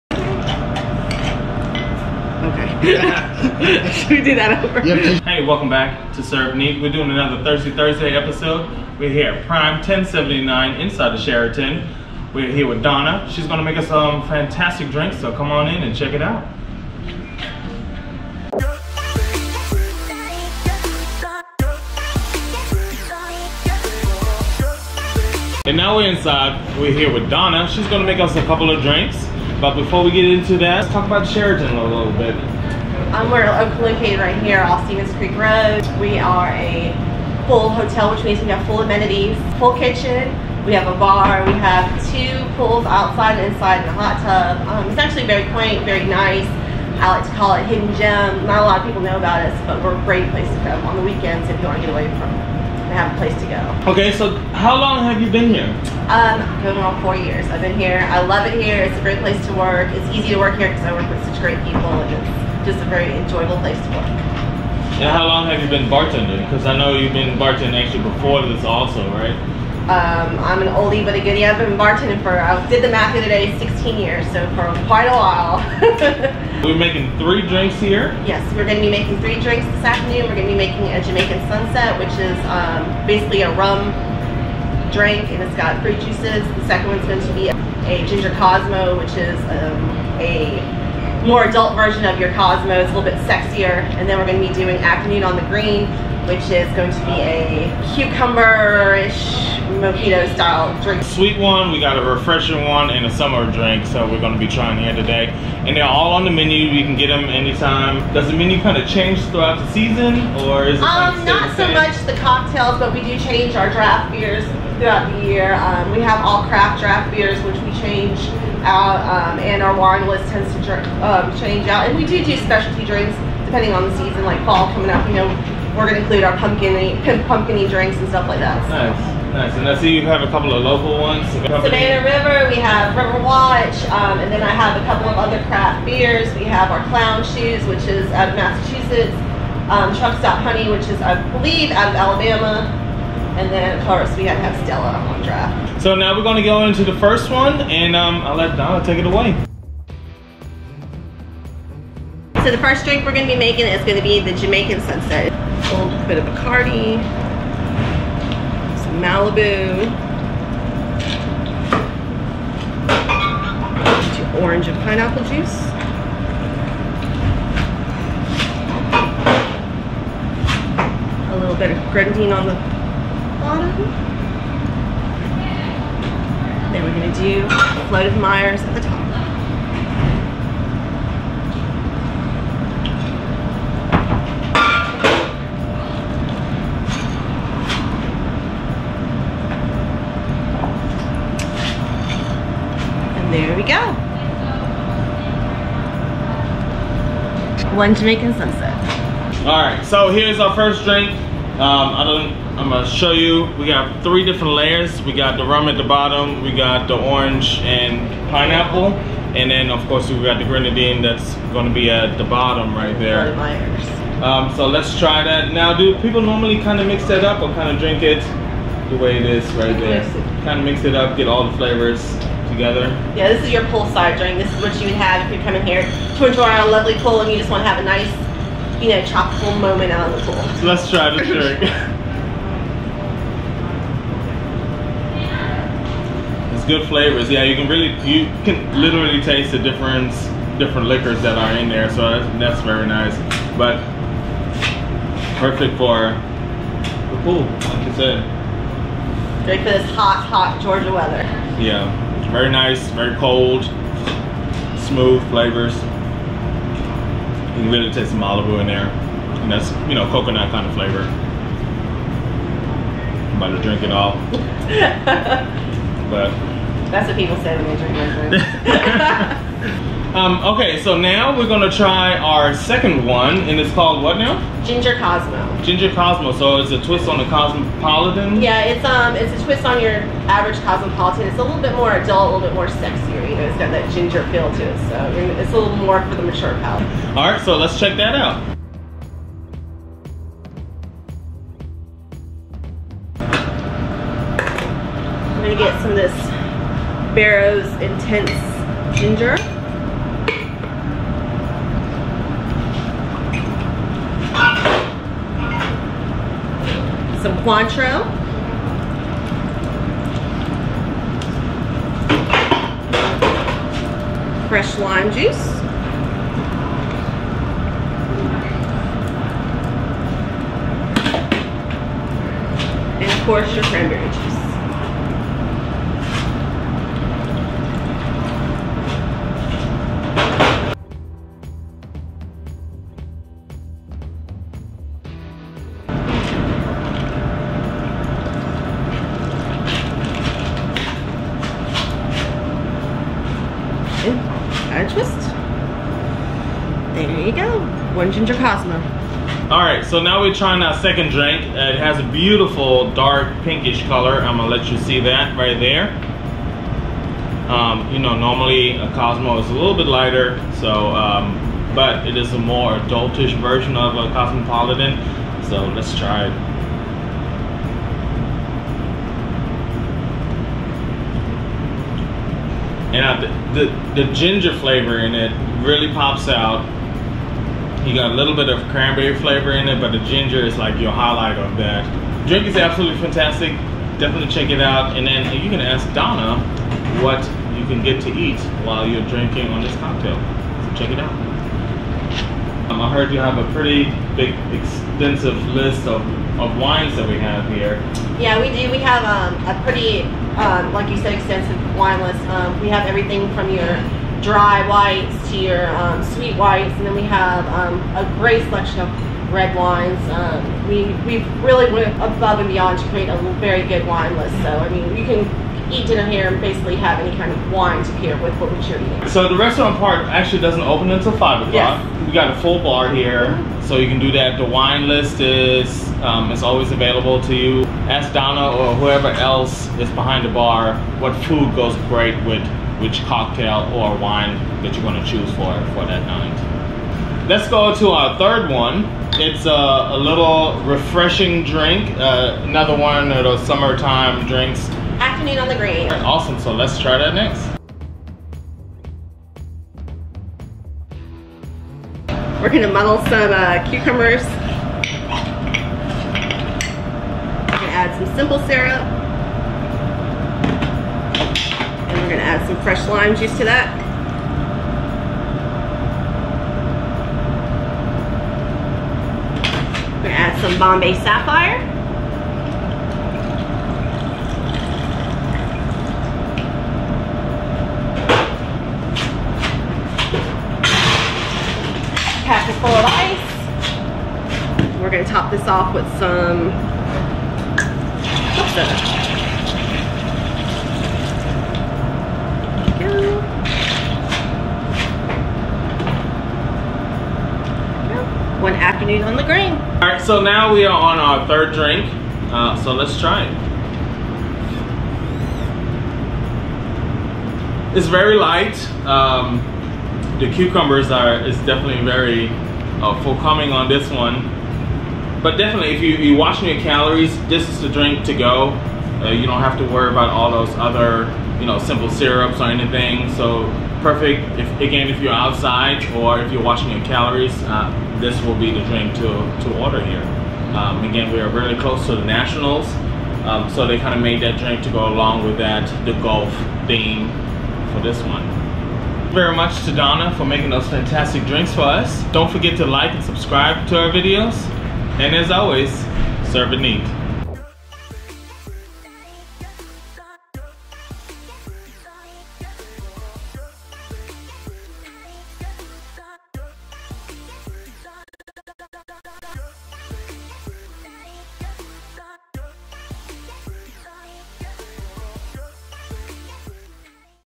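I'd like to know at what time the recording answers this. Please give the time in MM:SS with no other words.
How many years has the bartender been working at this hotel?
00:57.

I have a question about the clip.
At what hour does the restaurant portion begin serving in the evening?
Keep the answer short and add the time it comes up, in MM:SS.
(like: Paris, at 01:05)
5 o'clock, at 07:01.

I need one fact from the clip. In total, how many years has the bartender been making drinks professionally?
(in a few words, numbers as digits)
16.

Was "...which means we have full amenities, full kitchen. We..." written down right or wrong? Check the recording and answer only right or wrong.
right.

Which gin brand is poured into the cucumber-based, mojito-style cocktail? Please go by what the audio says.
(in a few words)
Bombay Sapphire.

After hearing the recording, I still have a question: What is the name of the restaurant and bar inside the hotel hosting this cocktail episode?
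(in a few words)
Prime 1079.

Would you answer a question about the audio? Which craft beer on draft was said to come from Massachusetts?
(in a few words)
Clown Shoes.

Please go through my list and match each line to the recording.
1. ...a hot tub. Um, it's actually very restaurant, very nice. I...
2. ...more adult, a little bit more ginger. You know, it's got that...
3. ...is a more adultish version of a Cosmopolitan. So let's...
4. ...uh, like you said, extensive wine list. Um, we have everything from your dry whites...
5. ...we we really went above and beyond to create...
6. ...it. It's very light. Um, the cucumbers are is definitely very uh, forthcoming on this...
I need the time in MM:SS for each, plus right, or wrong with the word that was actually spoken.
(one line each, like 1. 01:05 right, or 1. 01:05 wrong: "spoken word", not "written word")
1. 00:43 wrong: "quaint", not "restaurant"
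2. 04:41 wrong: "sexier", not "ginger"
3. 06:02 right
4. 06:40 right
5. 06:50 right
6. 08:23 right.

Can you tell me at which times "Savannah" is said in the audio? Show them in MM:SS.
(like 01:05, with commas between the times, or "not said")
02:11.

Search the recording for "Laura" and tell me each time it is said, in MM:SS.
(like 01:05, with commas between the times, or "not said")
not said.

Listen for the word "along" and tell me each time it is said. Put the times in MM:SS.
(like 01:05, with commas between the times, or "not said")
08:54.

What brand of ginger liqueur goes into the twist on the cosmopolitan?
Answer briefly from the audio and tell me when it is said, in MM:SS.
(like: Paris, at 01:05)
Barrow's Intense Ginger, at 04:57.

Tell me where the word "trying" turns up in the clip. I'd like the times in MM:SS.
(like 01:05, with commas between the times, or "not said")
01:44, 05:50.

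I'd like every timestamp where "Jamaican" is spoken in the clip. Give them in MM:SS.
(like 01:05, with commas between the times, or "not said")
01:21, 02:34, 03:17.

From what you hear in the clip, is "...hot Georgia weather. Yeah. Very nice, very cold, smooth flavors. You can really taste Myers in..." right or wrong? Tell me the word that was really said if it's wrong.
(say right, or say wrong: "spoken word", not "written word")
wrong: "Malibu", not "Myers".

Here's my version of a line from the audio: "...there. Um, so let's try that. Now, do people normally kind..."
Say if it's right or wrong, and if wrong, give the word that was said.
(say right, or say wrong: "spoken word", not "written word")
right.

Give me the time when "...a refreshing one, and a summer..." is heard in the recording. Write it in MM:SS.
01:41.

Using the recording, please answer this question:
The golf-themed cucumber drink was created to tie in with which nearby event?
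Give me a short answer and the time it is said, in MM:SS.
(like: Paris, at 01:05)
the Nationals, at 08:51.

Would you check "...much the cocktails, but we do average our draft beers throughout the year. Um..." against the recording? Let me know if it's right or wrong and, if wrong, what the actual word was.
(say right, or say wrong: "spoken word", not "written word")
wrong: "change", not "average".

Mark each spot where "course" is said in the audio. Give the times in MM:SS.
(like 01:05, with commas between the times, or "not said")
02:23, 03:29, 05:23.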